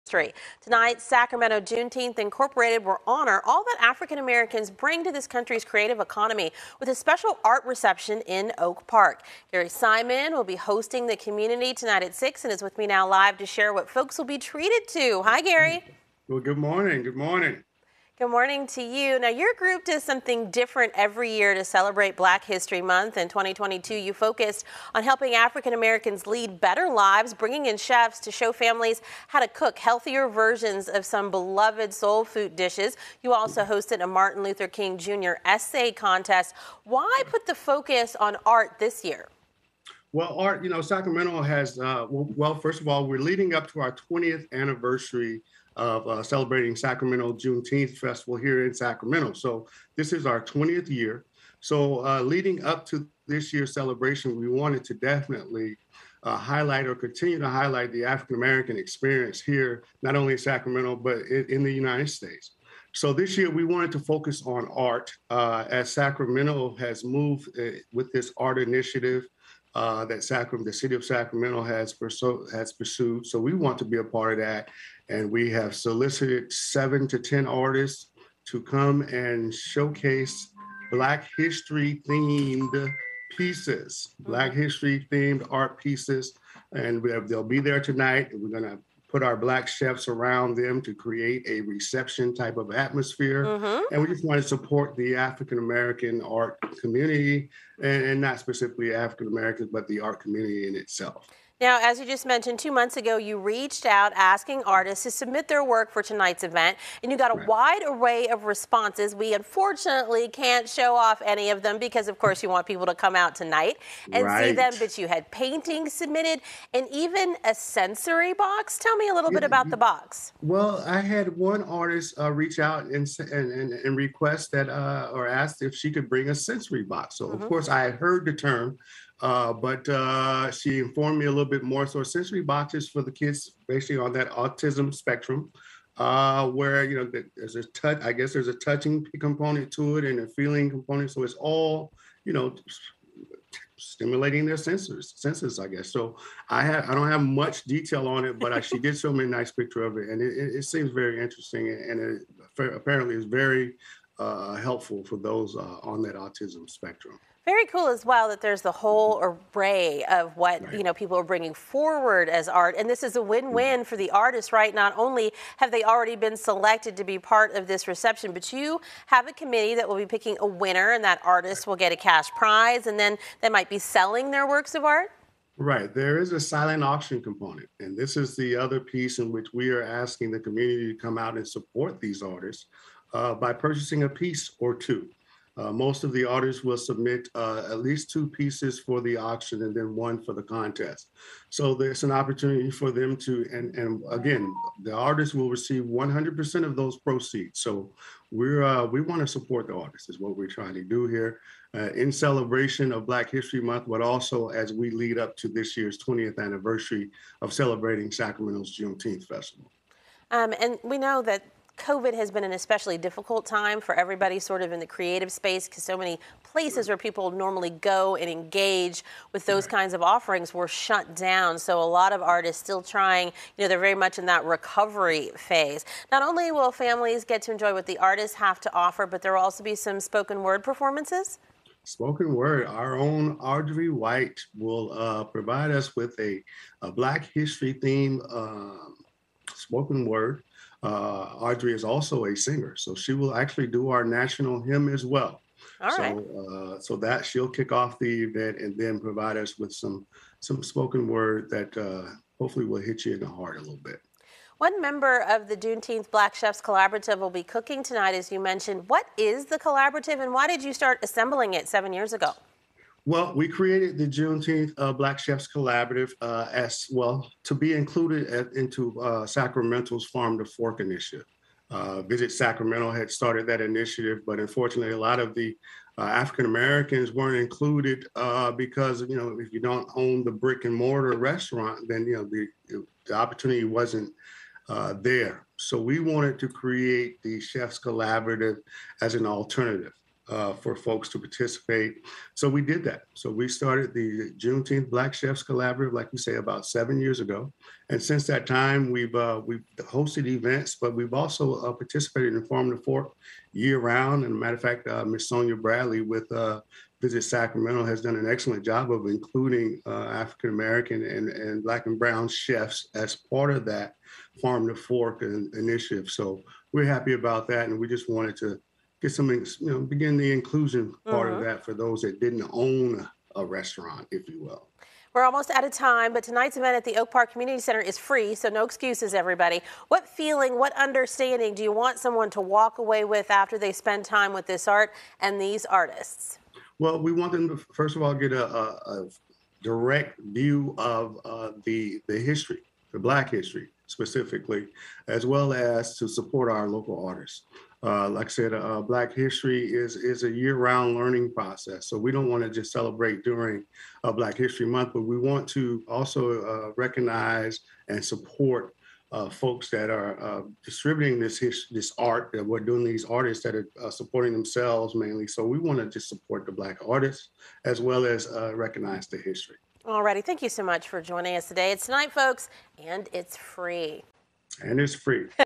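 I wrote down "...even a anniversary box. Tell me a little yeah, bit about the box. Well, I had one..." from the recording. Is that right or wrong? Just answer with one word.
wrong.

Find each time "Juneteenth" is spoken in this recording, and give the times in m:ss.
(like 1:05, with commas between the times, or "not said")
0:01, 0:47, 3:28, 4:15, 4:24, 4:54.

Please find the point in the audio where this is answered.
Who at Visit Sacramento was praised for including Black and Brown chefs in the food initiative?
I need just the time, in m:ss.
5:05.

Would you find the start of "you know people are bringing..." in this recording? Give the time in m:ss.
2:40.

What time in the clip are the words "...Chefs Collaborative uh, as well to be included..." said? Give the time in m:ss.
4:25.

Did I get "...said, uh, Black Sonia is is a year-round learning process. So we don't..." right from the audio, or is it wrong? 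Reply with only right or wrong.
wrong.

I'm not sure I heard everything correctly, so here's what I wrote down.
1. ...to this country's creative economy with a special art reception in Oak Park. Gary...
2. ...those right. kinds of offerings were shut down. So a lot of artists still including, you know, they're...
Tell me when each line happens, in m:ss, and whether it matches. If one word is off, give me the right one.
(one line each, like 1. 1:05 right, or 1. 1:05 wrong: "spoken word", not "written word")
1. 0:05 right
2. 3:39 wrong: "trying", not "including".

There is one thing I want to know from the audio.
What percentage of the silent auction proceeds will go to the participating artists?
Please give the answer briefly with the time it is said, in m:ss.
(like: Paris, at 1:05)
100%, at 3:15.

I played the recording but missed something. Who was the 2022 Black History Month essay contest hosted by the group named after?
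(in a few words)
Martin Luther King Jr.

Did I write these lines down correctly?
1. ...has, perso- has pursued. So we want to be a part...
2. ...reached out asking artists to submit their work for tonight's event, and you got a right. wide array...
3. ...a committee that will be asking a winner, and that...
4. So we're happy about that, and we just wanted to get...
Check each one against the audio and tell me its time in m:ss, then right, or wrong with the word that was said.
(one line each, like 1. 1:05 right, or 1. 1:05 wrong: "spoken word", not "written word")
1. 1:11 right
2. 1:43 right
3. 2:49 wrong: "picking", not "asking"
4. 5:16 right.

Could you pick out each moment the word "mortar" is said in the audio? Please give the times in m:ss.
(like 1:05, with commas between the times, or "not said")
4:40.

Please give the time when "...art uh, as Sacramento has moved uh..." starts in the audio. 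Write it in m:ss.
1:04.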